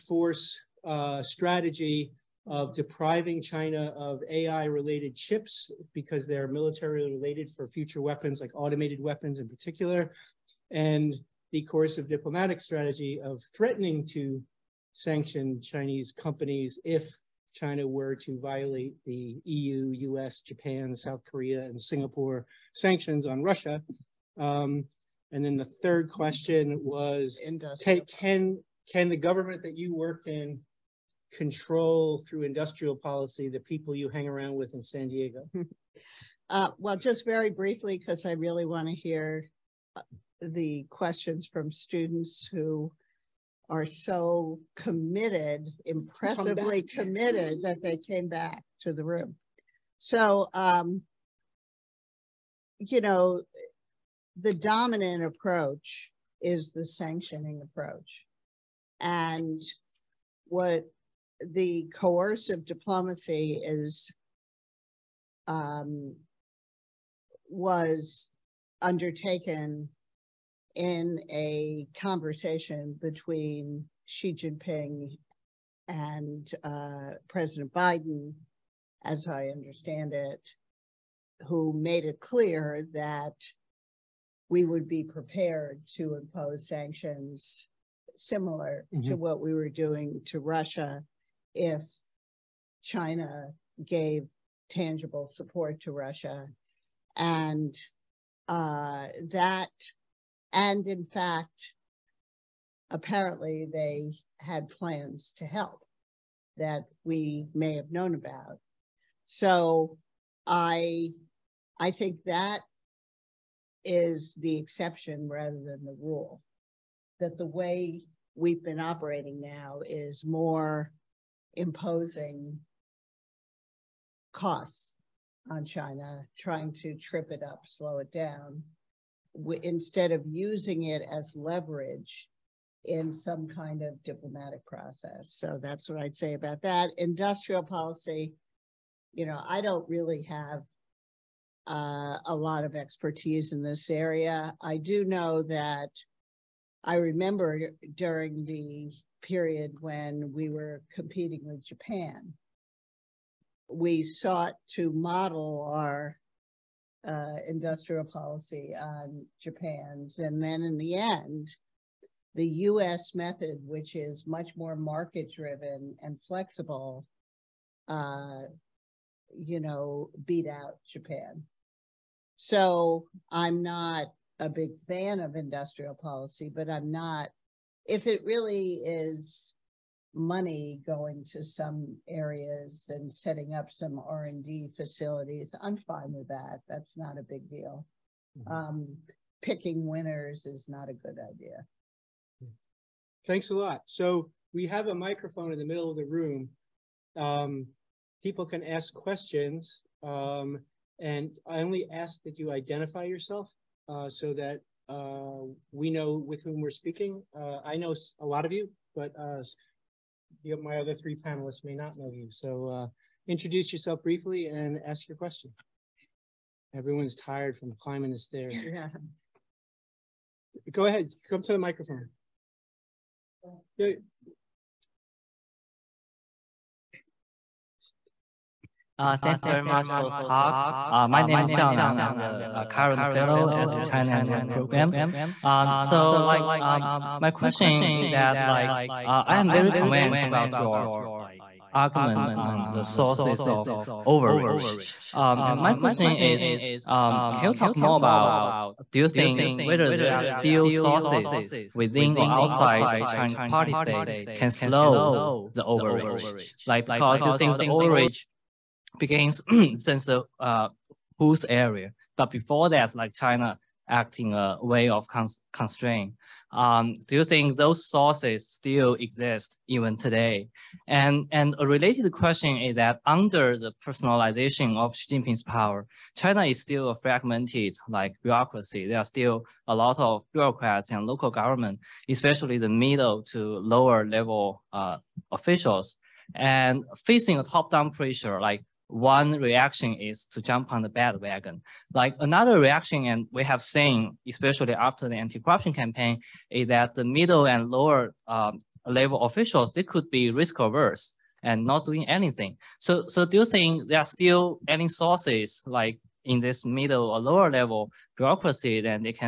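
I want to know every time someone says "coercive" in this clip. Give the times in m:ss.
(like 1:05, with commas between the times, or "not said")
0:11, 1:01.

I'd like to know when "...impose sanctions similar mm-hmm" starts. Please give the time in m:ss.
1:26.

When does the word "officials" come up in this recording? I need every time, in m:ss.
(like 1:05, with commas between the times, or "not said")
4:45, 4:59.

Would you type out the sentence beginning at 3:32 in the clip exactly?
So uh, introduce yourself briefly and ask your question.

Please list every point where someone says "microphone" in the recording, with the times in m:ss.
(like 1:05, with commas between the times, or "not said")
3:14, 3:41.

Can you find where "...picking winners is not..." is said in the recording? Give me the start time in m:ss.
3:09.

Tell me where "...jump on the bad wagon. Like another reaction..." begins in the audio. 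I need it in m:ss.
4:50.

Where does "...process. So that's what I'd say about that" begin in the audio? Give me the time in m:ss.
2:14.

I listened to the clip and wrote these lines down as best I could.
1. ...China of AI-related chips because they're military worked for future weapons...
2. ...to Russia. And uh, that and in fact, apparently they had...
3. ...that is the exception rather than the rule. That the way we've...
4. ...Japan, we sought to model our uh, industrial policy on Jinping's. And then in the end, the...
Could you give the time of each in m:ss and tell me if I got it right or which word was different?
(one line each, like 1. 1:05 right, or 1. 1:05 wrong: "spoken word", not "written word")
1. 0:03 wrong: "related", not "worked"
2. 1:35 right
3. 1:52 right
4. 2:31 wrong: "Japan", not "Jinping".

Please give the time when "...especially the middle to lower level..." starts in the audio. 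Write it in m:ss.
4:42.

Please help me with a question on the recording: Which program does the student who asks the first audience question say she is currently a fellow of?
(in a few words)
China Network Program.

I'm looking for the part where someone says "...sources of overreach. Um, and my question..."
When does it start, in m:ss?
4:02.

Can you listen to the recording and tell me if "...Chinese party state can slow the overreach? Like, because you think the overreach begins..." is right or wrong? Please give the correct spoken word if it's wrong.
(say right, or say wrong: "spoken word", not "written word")
right.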